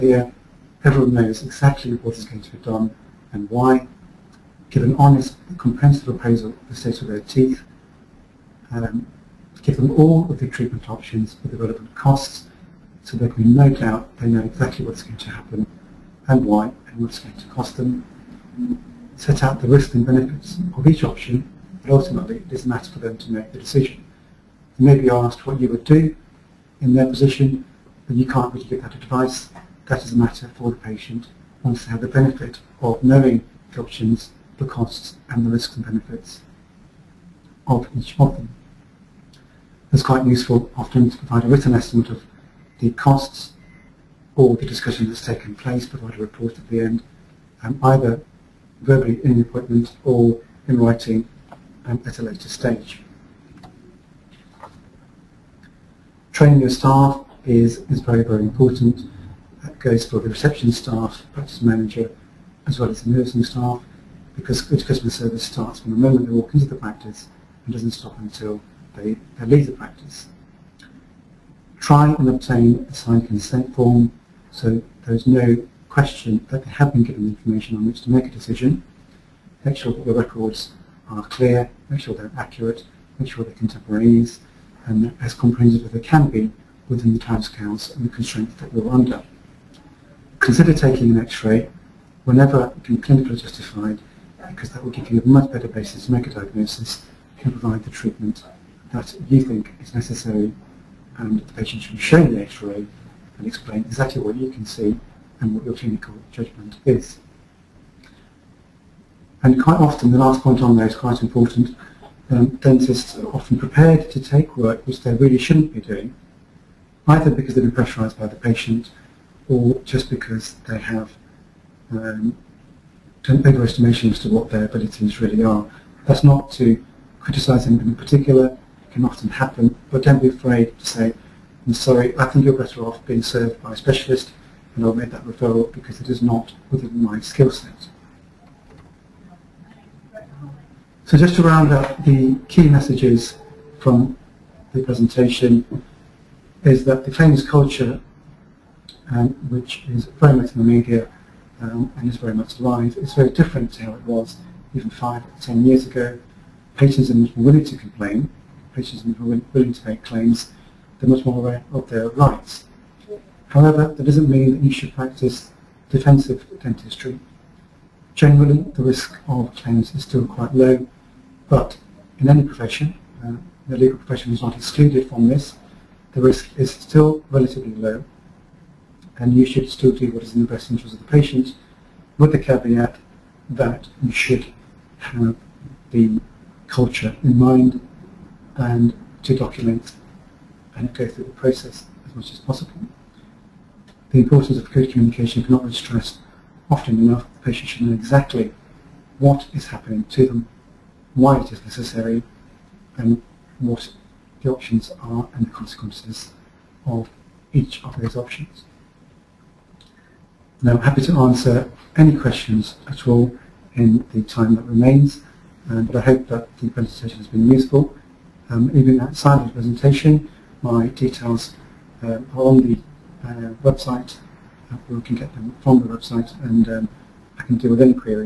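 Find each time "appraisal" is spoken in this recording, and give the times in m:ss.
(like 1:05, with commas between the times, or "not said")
0:06.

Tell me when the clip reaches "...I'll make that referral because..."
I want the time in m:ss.
2:14.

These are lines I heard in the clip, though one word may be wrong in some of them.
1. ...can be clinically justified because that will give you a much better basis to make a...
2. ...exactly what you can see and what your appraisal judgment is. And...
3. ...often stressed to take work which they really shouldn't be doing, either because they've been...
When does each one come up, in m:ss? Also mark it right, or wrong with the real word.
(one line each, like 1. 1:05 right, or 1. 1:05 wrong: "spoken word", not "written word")
1. 1:32 right
2. 1:43 wrong: "clinical", not "appraisal"
3. 1:53 wrong: "prepared", not "stressed".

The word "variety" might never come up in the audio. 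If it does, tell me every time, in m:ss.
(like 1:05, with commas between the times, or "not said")
not said.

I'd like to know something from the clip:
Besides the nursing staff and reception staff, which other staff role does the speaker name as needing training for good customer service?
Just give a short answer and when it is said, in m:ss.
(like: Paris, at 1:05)
Practice manager, at 1:01.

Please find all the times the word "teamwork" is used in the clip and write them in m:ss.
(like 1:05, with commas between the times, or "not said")
not said.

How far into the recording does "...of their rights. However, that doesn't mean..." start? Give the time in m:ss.
2:41.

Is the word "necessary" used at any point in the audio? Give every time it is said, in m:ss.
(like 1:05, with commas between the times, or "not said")
1:39, 3:21.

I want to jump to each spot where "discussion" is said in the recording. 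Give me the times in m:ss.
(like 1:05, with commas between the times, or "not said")
0:44.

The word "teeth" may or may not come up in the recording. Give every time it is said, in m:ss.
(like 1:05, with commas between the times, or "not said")
0:07.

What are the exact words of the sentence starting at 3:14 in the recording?
The importance of good communication cannot be stressed often enough.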